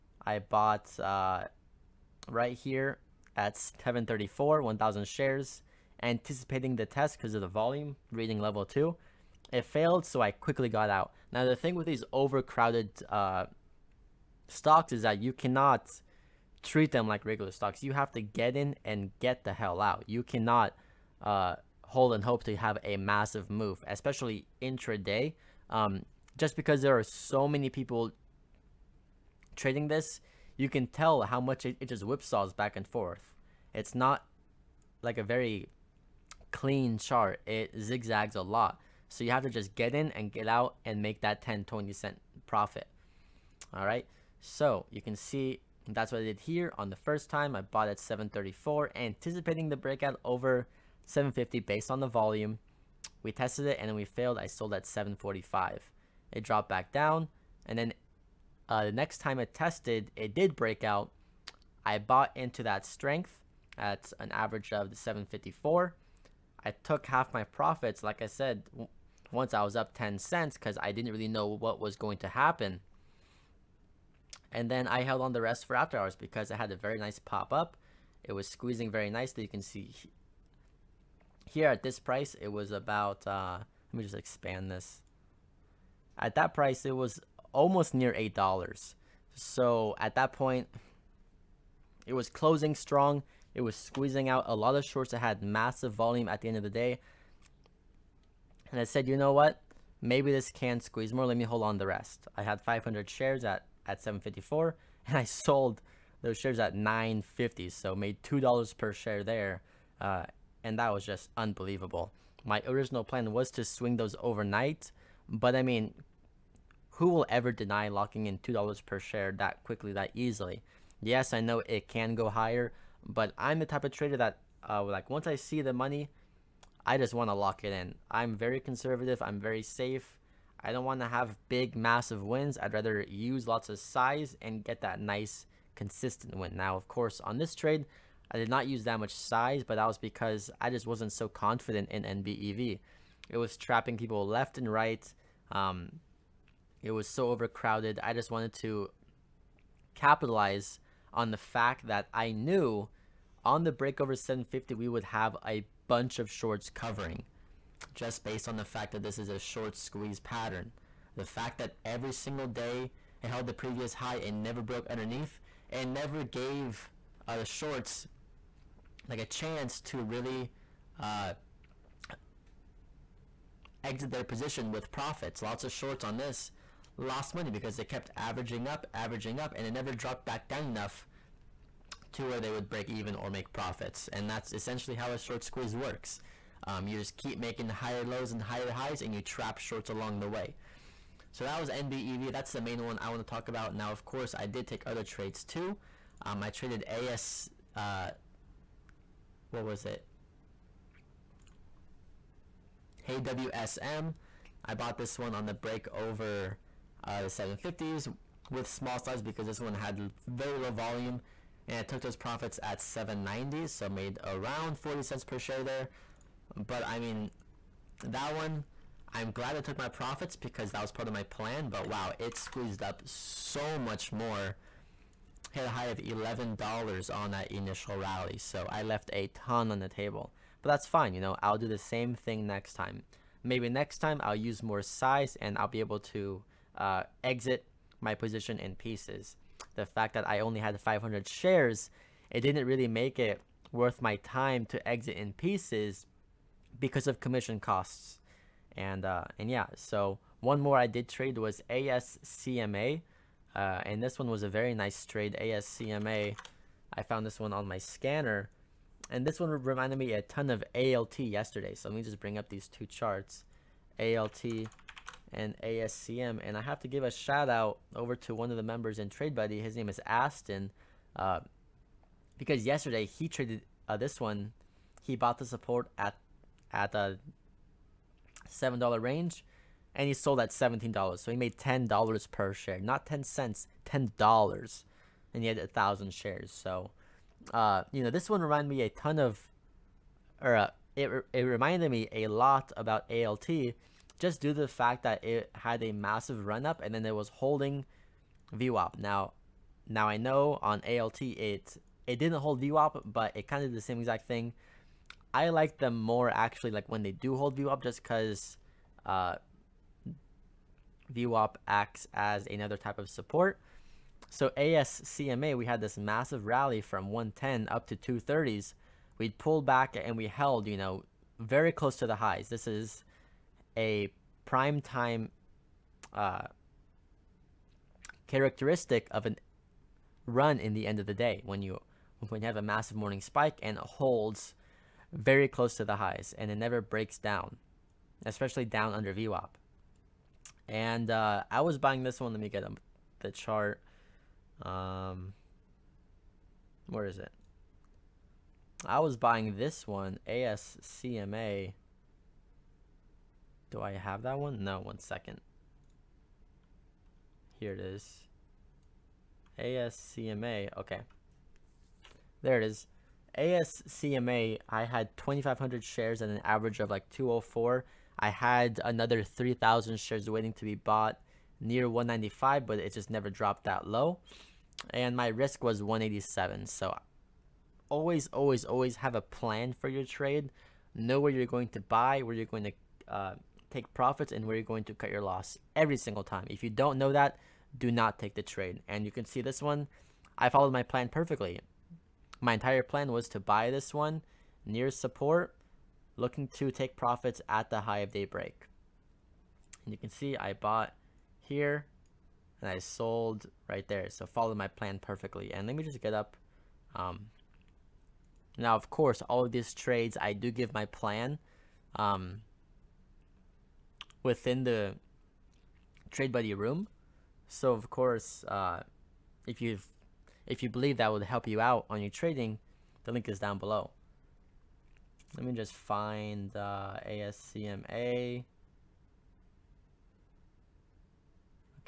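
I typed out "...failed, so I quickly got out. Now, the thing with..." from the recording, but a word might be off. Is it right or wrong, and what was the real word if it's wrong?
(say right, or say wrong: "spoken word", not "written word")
right.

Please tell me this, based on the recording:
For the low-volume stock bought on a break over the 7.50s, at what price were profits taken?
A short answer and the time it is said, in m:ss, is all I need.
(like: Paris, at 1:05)
7.90, at 3:32.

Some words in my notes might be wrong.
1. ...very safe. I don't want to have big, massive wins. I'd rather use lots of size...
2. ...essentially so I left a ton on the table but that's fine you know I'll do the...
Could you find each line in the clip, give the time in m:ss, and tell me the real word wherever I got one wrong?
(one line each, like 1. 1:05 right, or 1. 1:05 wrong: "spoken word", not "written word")
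1. 2:09 right
2. 3:47 wrong: "rally", not "essentially".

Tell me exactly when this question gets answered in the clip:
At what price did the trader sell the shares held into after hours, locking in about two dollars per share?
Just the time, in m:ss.
1:46.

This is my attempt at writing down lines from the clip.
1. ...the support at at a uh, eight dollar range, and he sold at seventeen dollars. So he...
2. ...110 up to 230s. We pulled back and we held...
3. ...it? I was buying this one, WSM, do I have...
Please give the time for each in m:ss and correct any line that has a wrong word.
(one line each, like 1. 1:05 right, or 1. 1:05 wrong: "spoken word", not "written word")
1. 4:35 wrong: "seven", not "eight"
2. 5:17 right
3. 5:47 wrong: "ASCMA", not "WSM".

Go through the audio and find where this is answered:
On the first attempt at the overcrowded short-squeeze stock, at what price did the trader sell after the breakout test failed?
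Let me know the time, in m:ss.
0:54.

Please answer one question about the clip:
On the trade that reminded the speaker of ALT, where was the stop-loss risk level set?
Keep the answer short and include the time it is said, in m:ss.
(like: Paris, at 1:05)
1.87, at 6:15.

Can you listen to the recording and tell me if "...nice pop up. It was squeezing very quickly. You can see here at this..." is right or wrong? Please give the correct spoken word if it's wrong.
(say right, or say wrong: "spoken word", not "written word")
wrong: "nicely", not "quickly".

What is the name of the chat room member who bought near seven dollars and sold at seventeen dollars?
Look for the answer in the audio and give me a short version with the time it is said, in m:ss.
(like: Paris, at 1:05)
Aston, at 4:30.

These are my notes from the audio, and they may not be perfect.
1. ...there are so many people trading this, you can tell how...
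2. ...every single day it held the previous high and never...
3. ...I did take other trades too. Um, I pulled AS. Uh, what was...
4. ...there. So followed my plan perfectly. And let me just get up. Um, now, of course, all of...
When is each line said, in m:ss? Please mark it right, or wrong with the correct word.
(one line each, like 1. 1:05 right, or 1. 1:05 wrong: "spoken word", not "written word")
1. 0:26 right
2. 2:41 right
3. 3:14 wrong: "traded", not "pulled"
4. 6:43 right.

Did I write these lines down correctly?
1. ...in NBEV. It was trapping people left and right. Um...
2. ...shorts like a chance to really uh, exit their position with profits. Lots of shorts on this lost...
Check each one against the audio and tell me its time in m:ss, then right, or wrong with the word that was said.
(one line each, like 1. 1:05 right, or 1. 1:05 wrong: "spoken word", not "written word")
1. 2:21 right
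2. 2:47 right.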